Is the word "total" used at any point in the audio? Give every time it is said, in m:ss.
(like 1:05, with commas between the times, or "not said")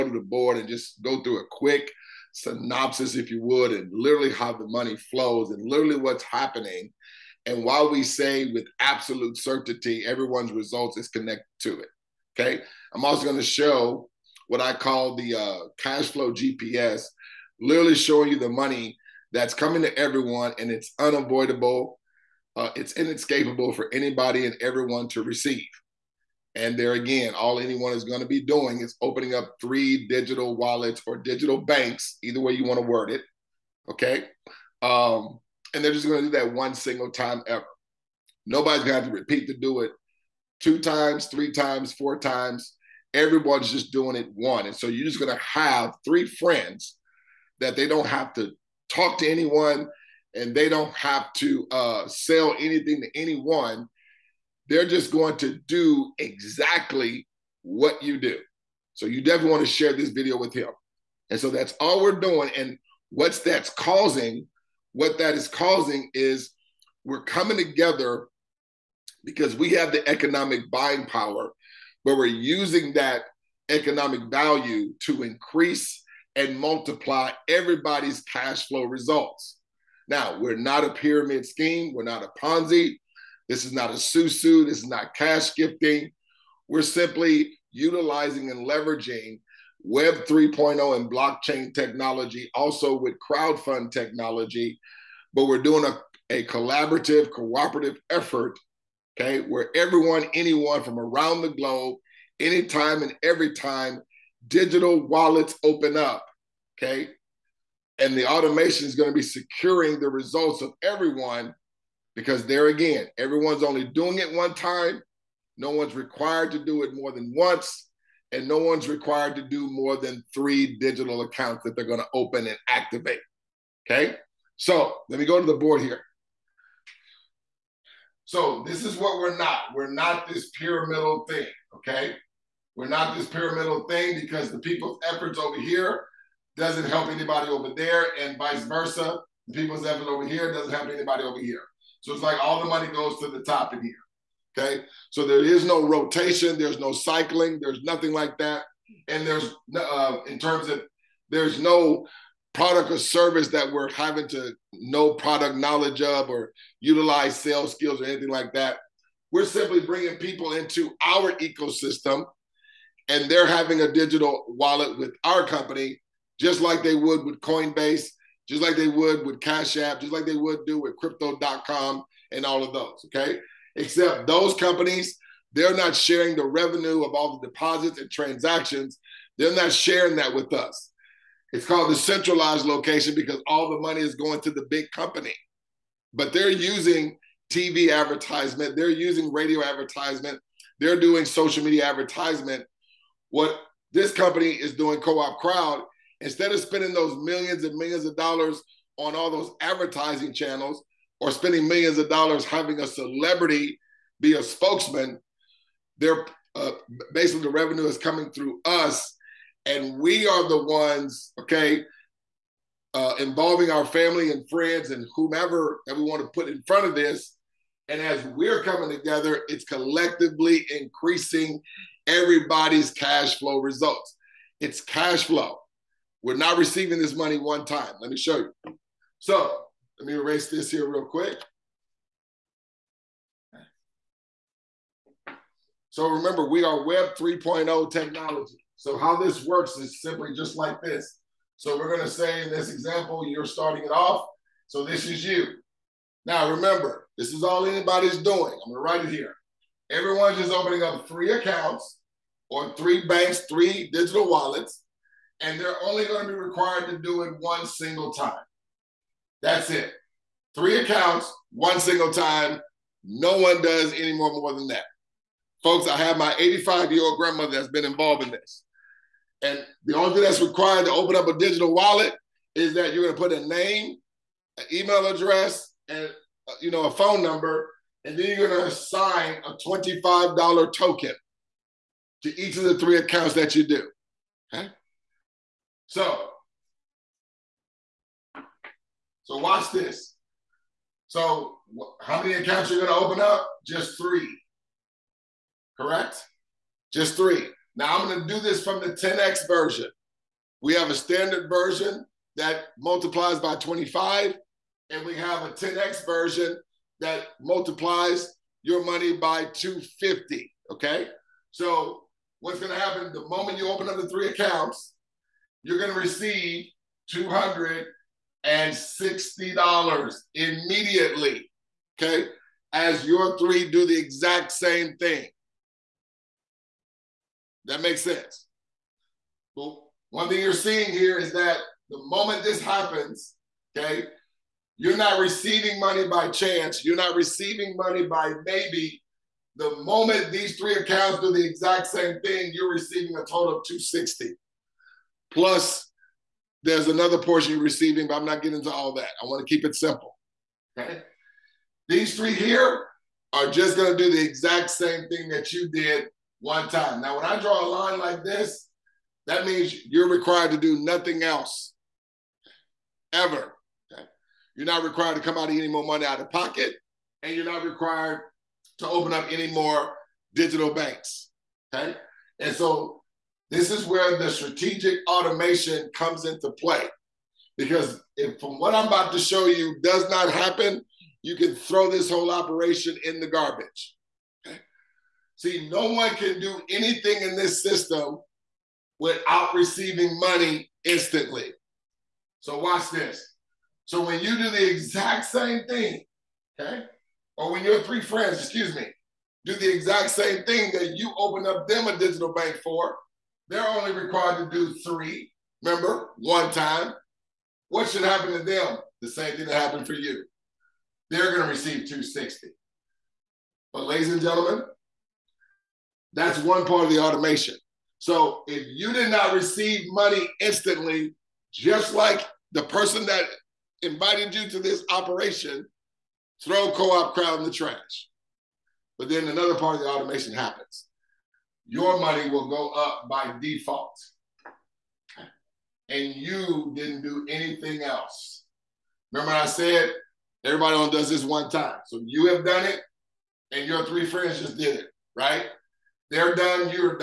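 5:43.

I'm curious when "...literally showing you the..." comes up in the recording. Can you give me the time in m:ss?
0:17.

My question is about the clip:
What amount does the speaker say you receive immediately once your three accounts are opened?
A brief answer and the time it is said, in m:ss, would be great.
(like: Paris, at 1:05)
$260, at 5:17.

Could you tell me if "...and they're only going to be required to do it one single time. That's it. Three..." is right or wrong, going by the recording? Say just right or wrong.
right.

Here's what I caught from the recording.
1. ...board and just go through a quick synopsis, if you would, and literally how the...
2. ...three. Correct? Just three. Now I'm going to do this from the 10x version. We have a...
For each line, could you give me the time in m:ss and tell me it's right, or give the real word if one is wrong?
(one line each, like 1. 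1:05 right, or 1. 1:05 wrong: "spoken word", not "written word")
1. 0:00 right
2. 4:53 right.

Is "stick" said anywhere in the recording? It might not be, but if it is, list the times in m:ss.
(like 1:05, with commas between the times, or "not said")
not said.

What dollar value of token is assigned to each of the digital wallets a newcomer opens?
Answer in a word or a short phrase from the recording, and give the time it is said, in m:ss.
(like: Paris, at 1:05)
$25, at 4:39.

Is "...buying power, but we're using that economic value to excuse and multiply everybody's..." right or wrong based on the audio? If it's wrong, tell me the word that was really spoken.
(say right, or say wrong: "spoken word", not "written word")
wrong: "increase", not "excuse".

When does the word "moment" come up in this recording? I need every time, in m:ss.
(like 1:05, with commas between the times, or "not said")
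5:13, 5:32, 5:39.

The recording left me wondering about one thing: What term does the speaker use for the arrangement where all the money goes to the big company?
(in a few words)
centralized location.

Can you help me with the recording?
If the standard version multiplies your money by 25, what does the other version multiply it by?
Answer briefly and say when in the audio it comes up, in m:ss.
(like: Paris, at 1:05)
250, at 5:07.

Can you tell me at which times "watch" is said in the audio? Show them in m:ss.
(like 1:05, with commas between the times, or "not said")
4:49, 6:32.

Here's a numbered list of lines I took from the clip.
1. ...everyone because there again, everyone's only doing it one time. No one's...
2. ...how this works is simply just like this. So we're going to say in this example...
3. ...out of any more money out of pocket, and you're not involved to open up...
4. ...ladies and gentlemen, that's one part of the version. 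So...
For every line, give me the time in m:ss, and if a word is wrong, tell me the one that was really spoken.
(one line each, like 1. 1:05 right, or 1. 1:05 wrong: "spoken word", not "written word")
1. 1:50 right
2. 3:58 right
3. 6:05 wrong: "required", not "involved"
4. 6:53 wrong: "automation", not "version".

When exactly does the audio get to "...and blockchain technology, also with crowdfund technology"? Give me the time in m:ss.
1:30.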